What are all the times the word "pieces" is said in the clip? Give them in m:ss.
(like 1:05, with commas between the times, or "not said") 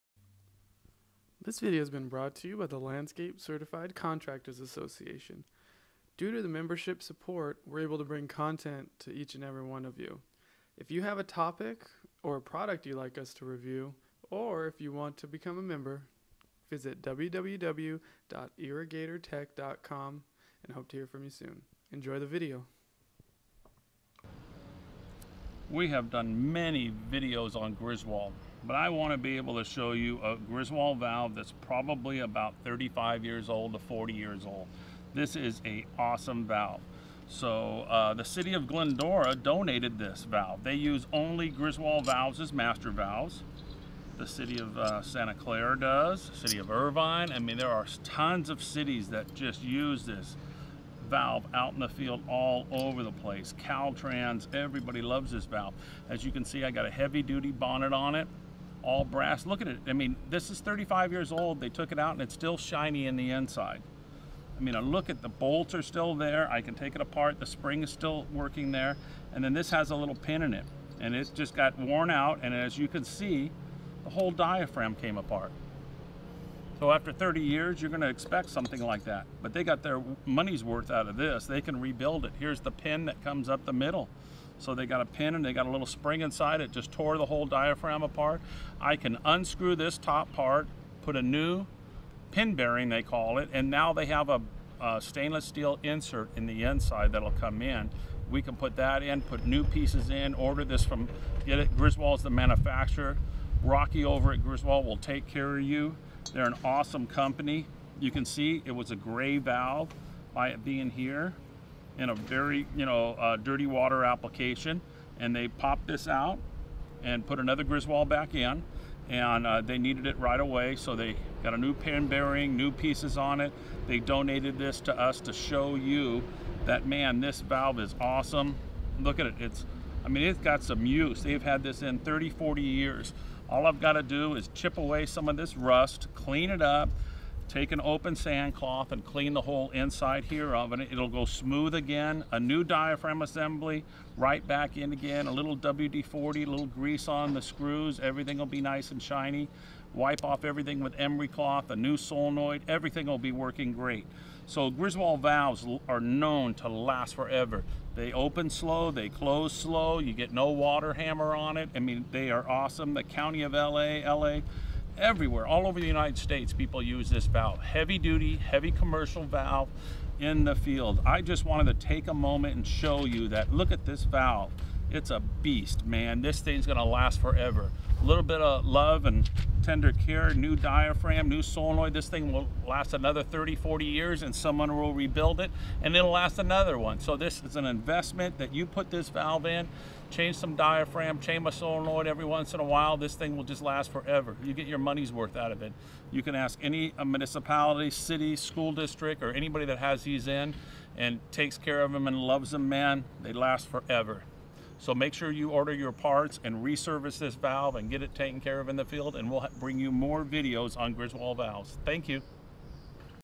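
1:39, 2:02.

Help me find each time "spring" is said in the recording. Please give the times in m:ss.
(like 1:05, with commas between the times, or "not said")
1:07, 1:25.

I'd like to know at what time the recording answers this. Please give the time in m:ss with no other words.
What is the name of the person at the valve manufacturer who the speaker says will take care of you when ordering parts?
1:43.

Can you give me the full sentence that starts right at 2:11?
They've had this in 30, 40 years.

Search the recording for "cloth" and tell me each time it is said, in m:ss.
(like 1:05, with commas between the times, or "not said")
2:18, 2:31.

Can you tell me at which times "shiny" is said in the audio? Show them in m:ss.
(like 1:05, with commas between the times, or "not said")
1:02, 2:29.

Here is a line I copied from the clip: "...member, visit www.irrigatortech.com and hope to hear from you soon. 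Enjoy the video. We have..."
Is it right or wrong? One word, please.
right.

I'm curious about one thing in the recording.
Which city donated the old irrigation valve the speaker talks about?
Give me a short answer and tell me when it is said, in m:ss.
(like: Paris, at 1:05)
Glendora, at 0:38.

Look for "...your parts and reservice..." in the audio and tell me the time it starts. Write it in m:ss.
3:25.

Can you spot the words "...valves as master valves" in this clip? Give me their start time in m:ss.
0:42.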